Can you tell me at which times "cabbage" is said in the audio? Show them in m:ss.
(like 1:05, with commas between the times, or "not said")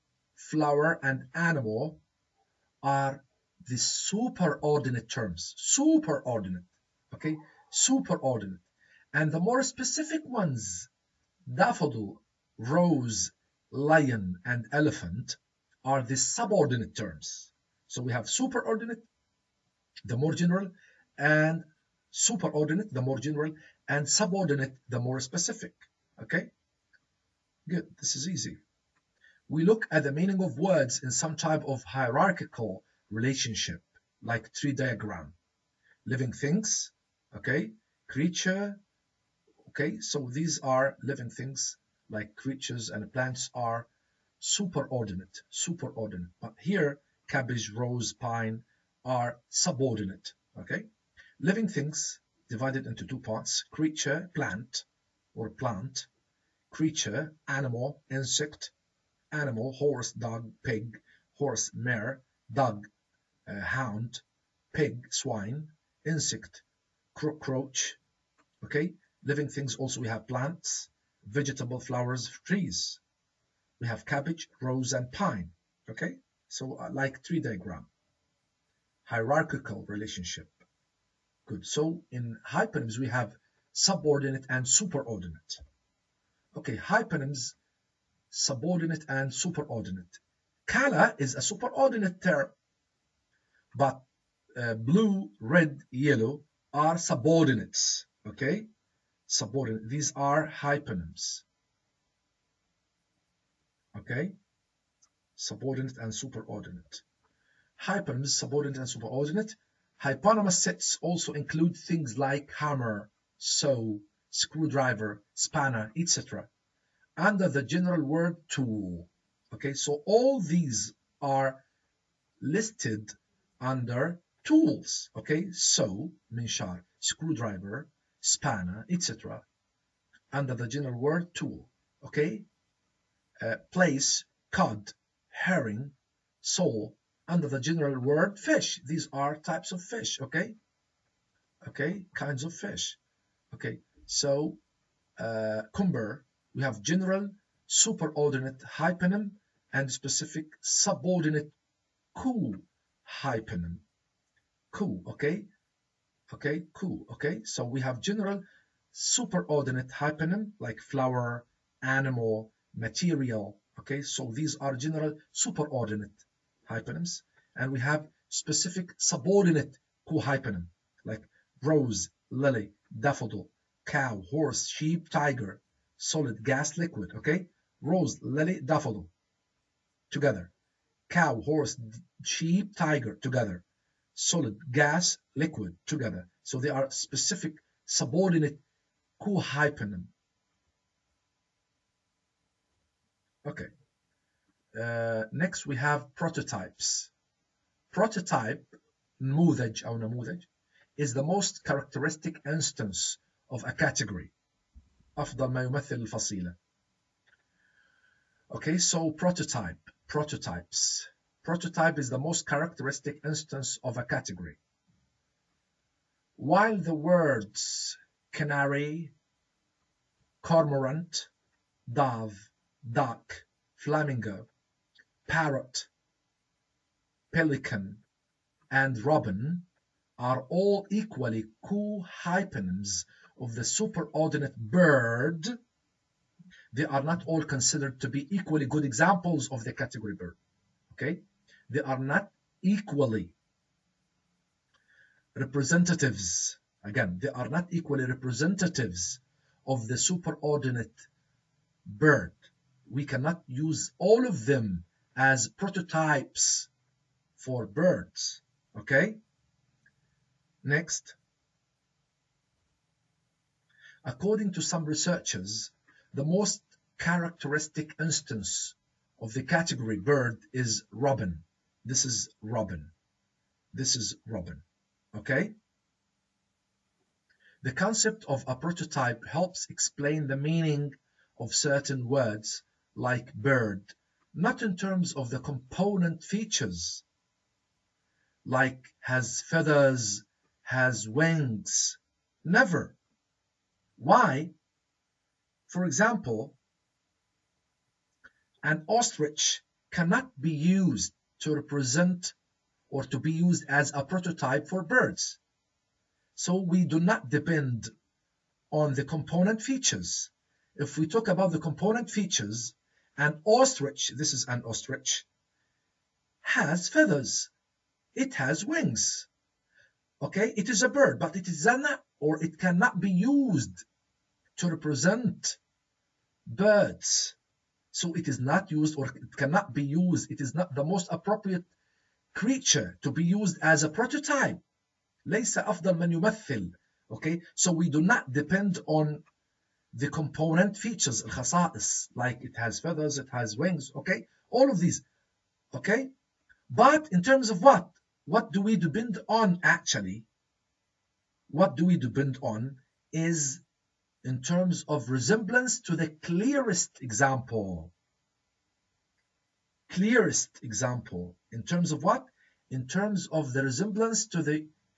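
0:47, 1:14.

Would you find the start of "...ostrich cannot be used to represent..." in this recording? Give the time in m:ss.
4:58.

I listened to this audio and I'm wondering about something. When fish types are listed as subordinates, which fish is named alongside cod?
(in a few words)
Herring.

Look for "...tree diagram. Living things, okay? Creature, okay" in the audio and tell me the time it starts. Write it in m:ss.
0:34.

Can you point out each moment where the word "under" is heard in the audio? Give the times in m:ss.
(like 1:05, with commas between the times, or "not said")
1:57, 2:03, 2:10, 2:17.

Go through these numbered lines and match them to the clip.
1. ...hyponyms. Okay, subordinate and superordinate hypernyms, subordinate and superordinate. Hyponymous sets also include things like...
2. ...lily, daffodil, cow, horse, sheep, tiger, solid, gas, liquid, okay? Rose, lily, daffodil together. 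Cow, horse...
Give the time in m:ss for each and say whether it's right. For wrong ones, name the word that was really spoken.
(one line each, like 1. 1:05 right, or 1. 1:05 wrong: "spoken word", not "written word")
1. 1:40 right
2. 2:52 right.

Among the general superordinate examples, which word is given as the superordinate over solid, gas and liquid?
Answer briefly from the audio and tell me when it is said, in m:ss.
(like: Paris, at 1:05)
Material, at 2:42.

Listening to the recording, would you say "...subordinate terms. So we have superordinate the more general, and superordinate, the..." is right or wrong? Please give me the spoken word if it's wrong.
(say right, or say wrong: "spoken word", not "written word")
right.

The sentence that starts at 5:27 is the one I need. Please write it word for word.
So it is not used or it cannot be used.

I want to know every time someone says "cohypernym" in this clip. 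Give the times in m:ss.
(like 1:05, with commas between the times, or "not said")
2:50, 3:09.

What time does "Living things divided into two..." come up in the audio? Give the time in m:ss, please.
0:51.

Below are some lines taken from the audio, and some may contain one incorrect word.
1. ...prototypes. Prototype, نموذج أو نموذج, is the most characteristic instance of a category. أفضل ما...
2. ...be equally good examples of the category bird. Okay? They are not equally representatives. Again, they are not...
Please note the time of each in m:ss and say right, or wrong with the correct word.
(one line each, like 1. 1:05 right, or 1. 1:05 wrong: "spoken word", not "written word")
1. 3:16 right
2. 3:58 right.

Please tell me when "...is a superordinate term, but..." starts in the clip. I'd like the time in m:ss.
1:31.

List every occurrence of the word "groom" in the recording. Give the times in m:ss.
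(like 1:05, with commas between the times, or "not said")
not said.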